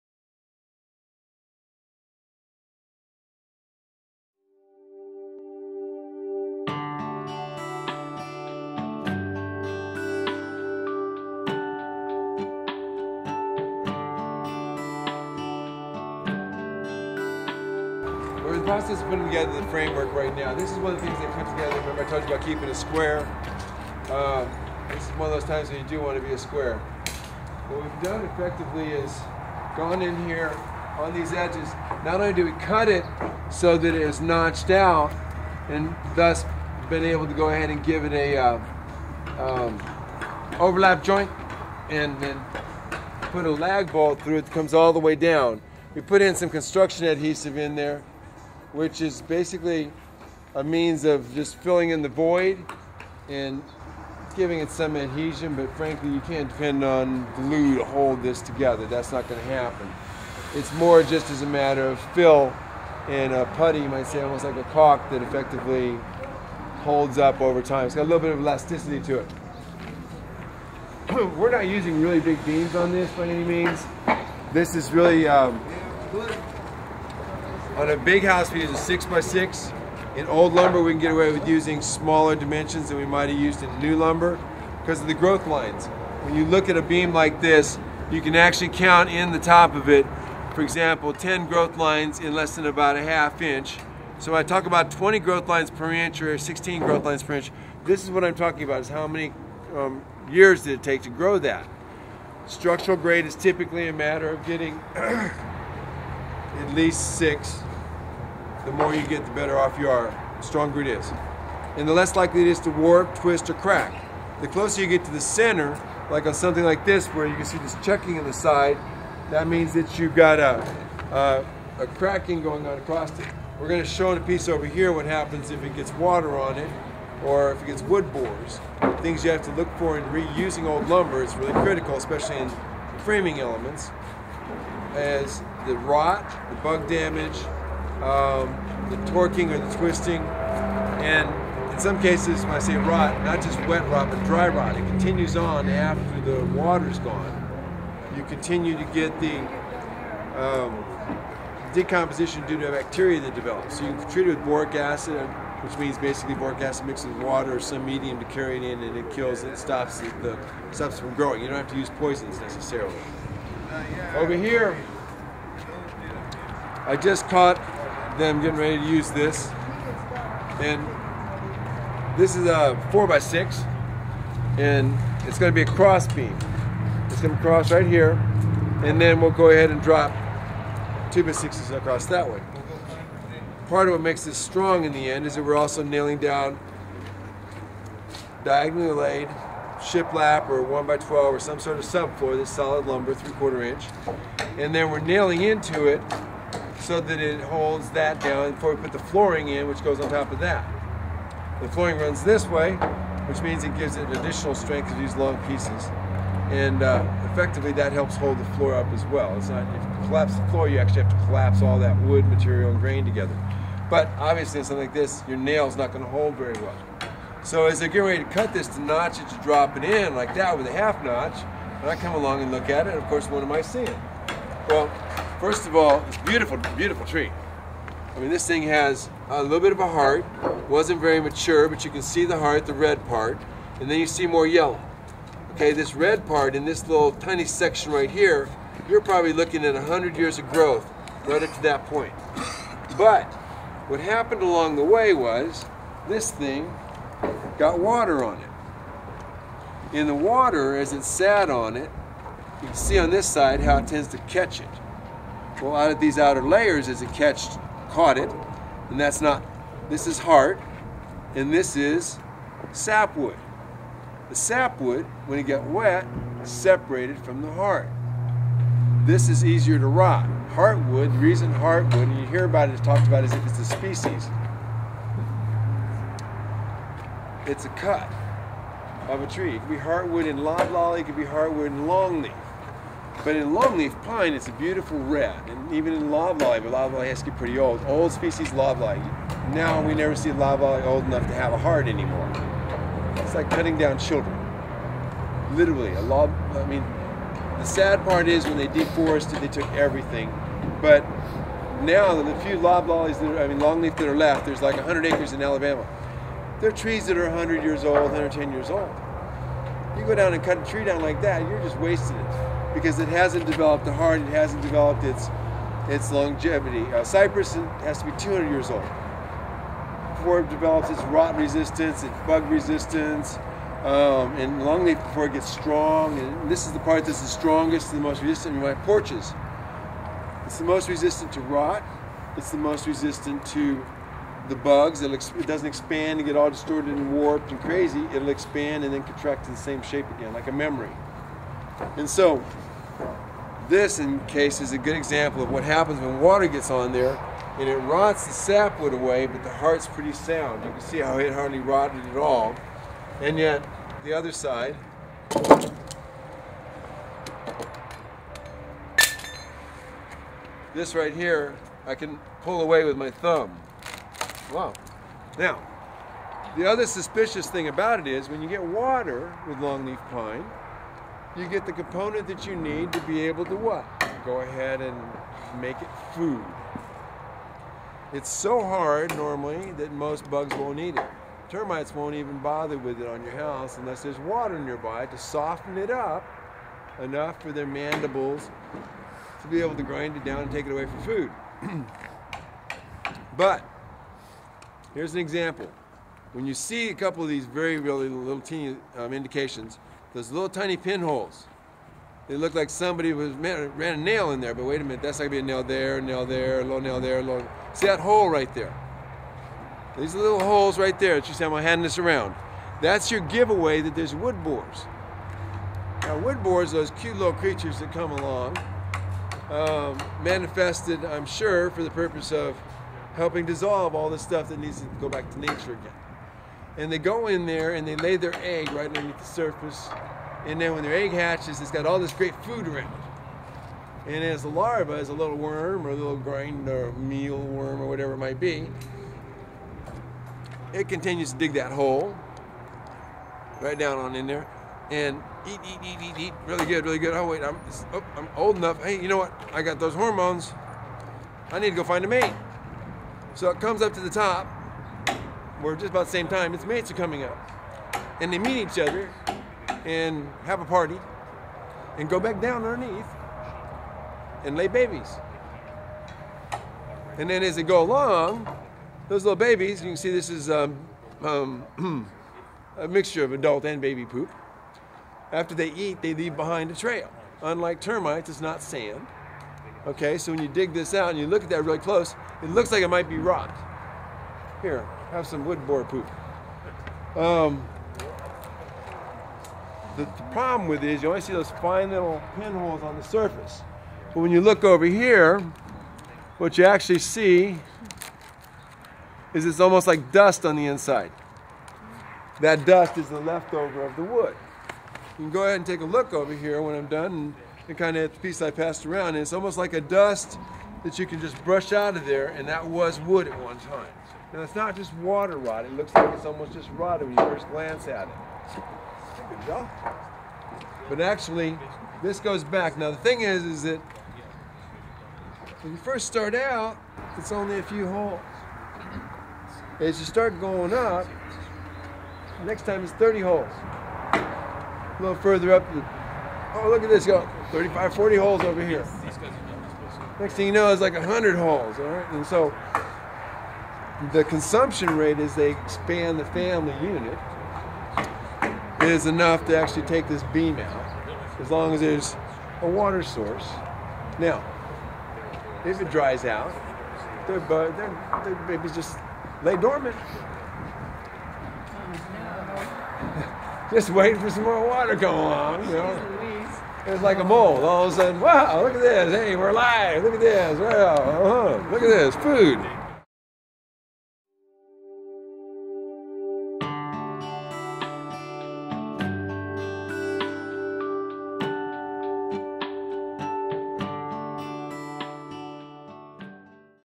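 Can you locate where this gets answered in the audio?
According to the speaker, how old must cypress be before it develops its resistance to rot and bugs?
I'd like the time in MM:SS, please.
05:18.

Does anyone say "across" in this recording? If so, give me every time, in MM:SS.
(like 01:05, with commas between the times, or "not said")
02:02, 03:01.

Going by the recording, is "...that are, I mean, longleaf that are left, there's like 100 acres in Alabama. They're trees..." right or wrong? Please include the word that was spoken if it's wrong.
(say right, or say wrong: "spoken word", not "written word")
right.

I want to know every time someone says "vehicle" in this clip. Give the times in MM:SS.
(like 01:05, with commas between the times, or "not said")
not said.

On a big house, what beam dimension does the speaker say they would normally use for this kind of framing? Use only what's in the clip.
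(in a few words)
6x6.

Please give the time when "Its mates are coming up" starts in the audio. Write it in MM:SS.
07:36.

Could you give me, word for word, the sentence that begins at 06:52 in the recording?
That's your giveaway that there's wood borers.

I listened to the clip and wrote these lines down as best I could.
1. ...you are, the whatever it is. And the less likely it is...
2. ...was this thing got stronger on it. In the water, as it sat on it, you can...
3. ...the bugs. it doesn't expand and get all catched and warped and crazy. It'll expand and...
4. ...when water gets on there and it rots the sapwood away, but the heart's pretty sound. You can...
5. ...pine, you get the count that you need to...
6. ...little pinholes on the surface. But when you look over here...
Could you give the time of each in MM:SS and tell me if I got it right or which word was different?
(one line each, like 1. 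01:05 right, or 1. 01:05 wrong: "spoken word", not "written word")
1. 01:49 wrong: "stronger", not "whatever"
2. 04:05 wrong: "water", not "stronger"
3. 05:34 wrong: "distorted", not "catched"
4. 05:46 right
5. 06:10 wrong: "component", not "count"
6. 08:11 right.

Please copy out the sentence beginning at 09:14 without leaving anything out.
Now, if it dries out, their, their, their babies just lay dormant.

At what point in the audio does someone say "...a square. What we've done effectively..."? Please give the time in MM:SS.
00:26.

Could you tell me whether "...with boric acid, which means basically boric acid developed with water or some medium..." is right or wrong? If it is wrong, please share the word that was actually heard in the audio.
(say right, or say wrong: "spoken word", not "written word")
wrong: "mixed", not "developed".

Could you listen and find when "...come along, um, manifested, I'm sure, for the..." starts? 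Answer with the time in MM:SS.
06:57.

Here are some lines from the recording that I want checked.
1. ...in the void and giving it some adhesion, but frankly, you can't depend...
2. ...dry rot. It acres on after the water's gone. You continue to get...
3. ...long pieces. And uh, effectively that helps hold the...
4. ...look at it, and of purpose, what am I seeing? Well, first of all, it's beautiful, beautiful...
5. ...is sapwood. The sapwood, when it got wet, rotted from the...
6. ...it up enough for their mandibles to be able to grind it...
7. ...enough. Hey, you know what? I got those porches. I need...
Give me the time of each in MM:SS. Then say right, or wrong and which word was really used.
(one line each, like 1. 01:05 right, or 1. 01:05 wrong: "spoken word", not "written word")
1. 00:51 right
2. 02:24 wrong: "continues", not "acres"
3. 03:25 right
4. 03:42 wrong: "course", not "purpose"
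5. 04:21 wrong: "separated", not "rotted"
6. 06:25 right
7. 07:28 wrong: "hormones", not "porches".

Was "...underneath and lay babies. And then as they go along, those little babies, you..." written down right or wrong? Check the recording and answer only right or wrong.
right.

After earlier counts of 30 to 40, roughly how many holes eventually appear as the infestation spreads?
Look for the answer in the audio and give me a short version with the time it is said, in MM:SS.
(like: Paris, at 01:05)
100, at 09:00.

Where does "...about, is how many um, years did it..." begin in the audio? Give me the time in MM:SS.
01:38.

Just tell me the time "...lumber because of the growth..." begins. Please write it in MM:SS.
01:23.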